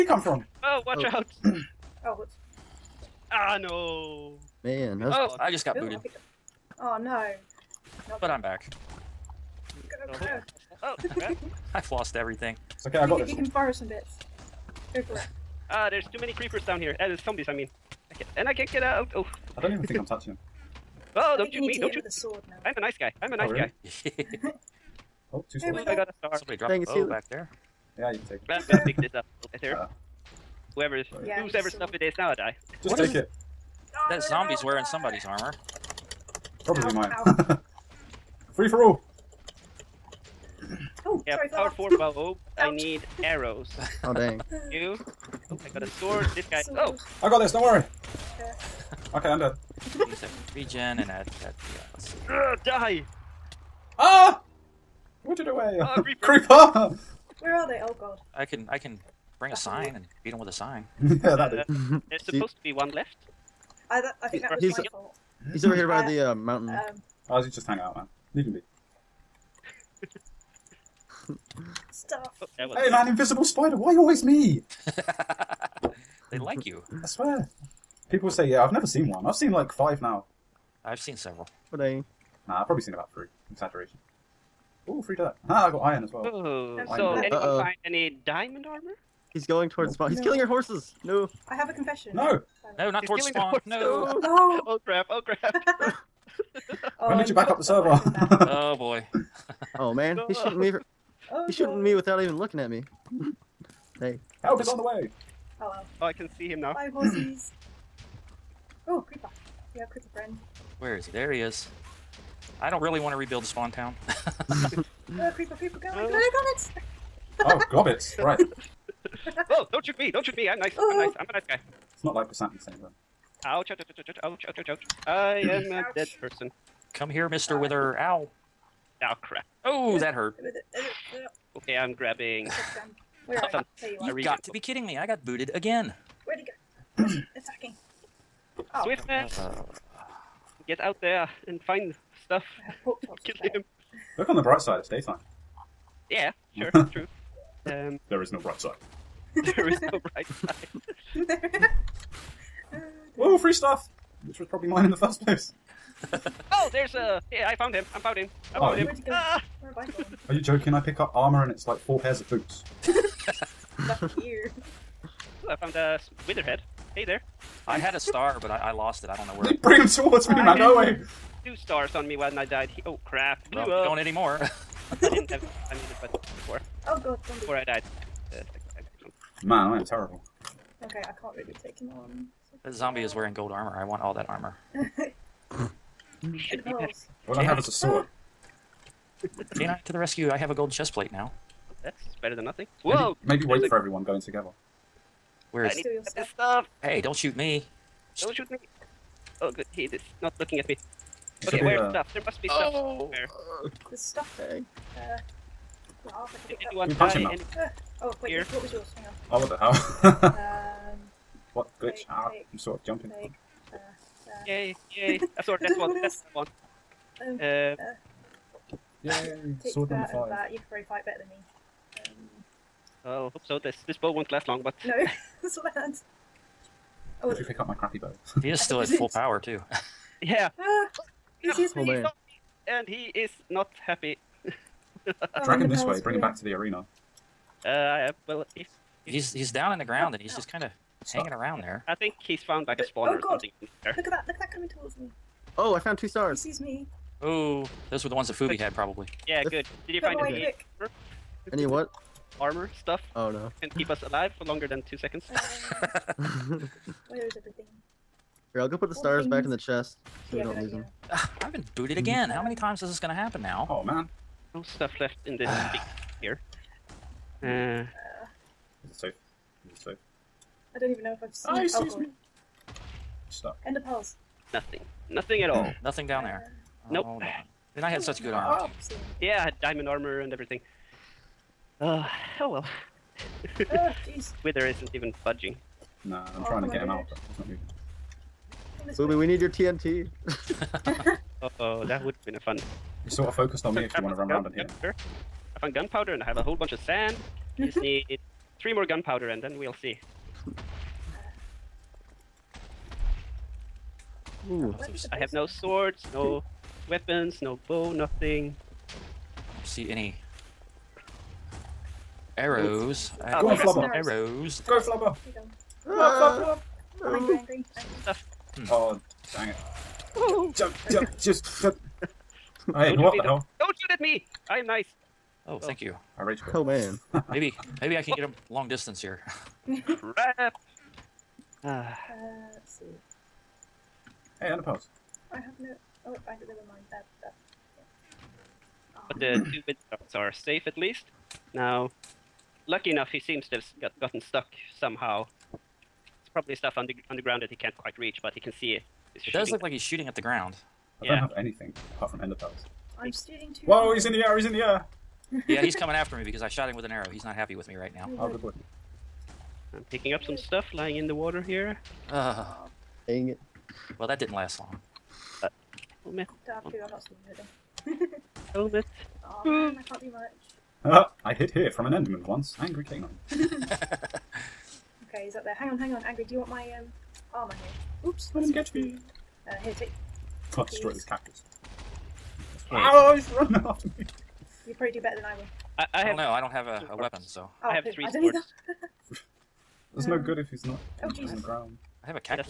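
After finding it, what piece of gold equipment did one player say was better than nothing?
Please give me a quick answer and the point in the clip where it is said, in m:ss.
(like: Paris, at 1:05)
chest plate, at 3:10.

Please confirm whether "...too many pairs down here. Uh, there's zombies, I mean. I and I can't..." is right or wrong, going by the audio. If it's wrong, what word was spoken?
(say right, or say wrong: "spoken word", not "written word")
wrong: "creepers", not "pairs".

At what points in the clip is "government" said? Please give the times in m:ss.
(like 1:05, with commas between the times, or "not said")
not said.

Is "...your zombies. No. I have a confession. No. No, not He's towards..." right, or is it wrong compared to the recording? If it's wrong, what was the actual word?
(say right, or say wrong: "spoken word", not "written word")
wrong: "horses", not "zombies".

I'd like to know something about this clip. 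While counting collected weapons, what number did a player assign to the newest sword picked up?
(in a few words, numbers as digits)
5.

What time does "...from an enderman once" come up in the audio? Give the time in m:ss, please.
6:11.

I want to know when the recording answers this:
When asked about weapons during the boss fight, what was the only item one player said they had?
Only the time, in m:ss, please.
5:52.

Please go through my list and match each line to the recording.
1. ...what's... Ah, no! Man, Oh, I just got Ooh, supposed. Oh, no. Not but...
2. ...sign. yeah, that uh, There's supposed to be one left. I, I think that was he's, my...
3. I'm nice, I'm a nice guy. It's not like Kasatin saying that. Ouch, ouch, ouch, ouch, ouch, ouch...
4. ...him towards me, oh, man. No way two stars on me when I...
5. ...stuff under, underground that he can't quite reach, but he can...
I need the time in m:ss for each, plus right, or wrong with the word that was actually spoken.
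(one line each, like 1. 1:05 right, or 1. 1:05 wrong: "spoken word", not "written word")
1. 0:02 wrong: "booted", not "supposed"
2. 1:00 right
3. 2:00 right
4. 2:49 right
5. 5:46 right.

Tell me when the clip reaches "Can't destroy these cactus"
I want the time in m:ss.
6:20.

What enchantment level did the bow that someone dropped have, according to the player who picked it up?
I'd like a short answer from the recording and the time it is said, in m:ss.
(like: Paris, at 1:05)
power 4, at 0:41.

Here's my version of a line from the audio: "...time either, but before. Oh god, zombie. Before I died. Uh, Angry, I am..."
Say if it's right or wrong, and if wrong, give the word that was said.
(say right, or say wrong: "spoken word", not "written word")
wrong: "Man", not "Angry".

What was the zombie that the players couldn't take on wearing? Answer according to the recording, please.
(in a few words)
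gold armor.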